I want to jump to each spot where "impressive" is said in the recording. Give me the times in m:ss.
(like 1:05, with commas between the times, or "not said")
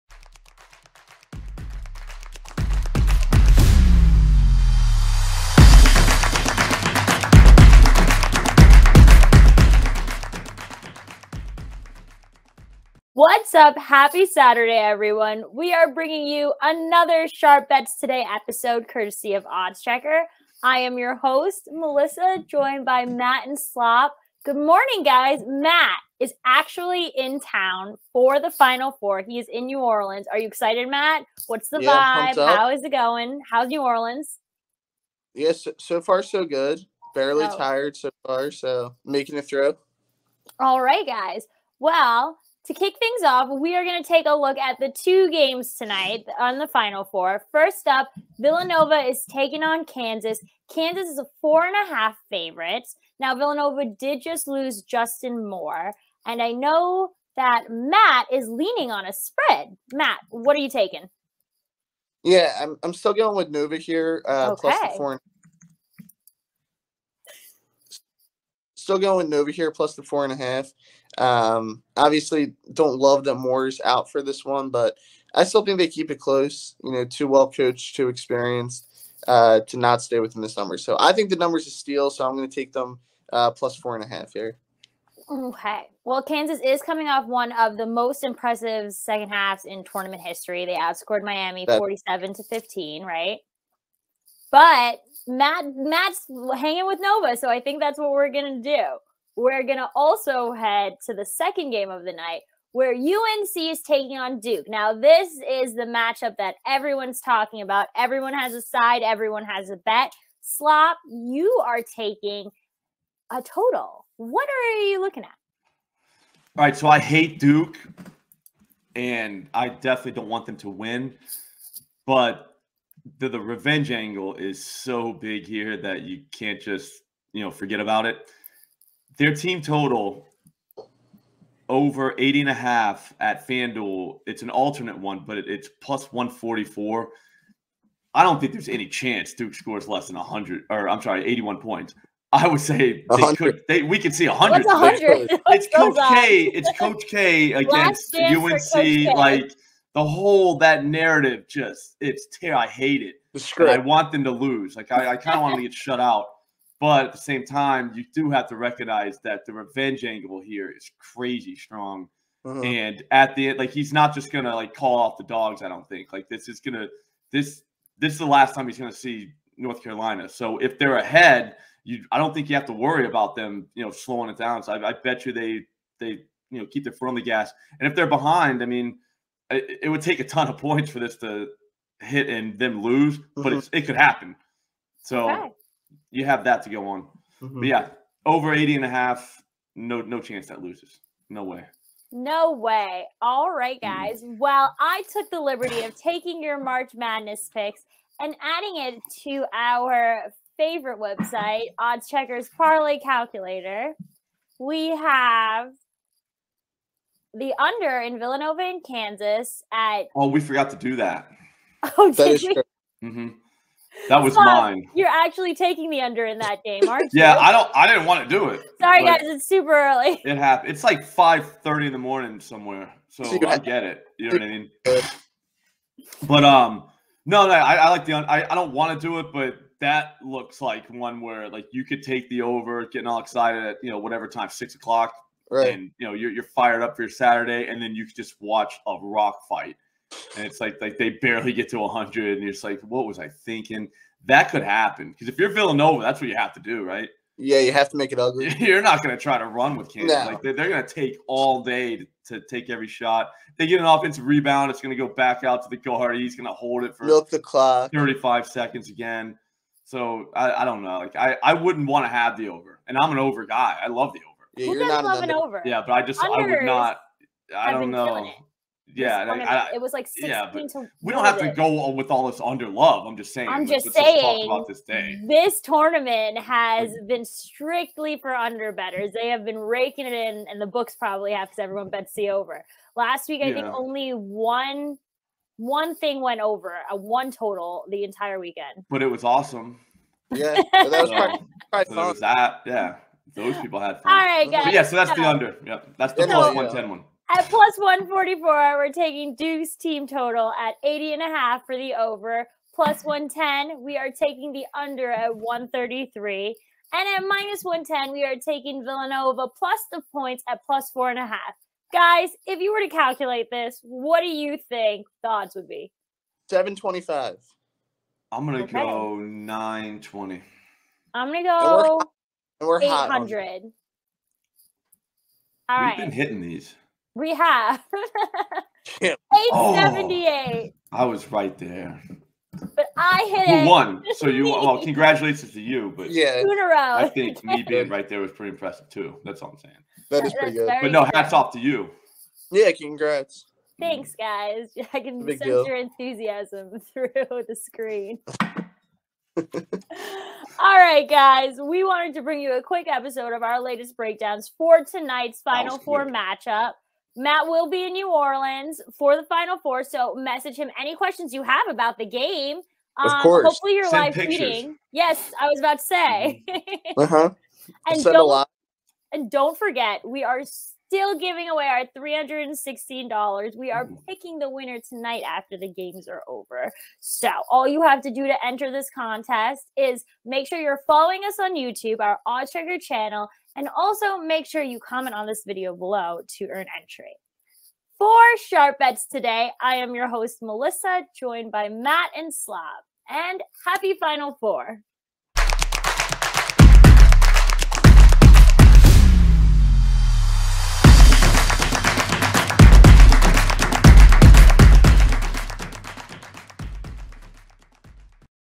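1:28, 5:38.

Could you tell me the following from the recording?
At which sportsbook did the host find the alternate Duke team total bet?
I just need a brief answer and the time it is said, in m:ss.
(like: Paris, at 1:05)
FanDuel, at 2:13.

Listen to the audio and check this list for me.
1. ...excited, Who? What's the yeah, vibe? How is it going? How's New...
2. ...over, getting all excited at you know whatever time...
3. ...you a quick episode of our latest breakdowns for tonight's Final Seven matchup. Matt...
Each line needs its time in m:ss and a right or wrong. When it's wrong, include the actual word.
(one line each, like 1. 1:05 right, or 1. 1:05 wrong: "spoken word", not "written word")
1. 0:30 wrong: "Matt", not "Who"
2. 3:52 right
3. 5:52 wrong: "Four", not "Seven".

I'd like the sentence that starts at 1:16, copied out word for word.
You know, too well coached, too experienced uh, to not stay within this number.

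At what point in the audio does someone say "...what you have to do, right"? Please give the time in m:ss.
4:06.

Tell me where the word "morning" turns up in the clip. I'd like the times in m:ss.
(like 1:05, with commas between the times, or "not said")
0:24, 3:41.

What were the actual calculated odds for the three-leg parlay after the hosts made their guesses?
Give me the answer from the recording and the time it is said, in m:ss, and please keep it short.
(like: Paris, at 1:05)
878, at 5:29.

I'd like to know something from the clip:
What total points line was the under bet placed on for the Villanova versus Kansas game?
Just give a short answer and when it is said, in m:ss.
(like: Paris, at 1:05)
133, at 5:05.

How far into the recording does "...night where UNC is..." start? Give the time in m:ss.
1:42.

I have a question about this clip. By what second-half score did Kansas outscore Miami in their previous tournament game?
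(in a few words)
47 to 15.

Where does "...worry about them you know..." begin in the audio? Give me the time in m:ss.
2:52.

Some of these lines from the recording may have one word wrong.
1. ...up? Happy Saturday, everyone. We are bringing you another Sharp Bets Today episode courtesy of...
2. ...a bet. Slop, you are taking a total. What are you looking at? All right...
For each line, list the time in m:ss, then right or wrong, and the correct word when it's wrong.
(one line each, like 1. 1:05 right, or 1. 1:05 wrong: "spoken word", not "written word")
1. 0:13 right
2. 1:49 right.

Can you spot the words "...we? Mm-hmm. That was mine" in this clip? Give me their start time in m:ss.
3:33.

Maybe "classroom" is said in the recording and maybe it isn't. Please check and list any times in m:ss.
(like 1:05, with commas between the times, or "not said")
not said.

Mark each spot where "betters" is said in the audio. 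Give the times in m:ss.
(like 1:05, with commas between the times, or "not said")
4:38.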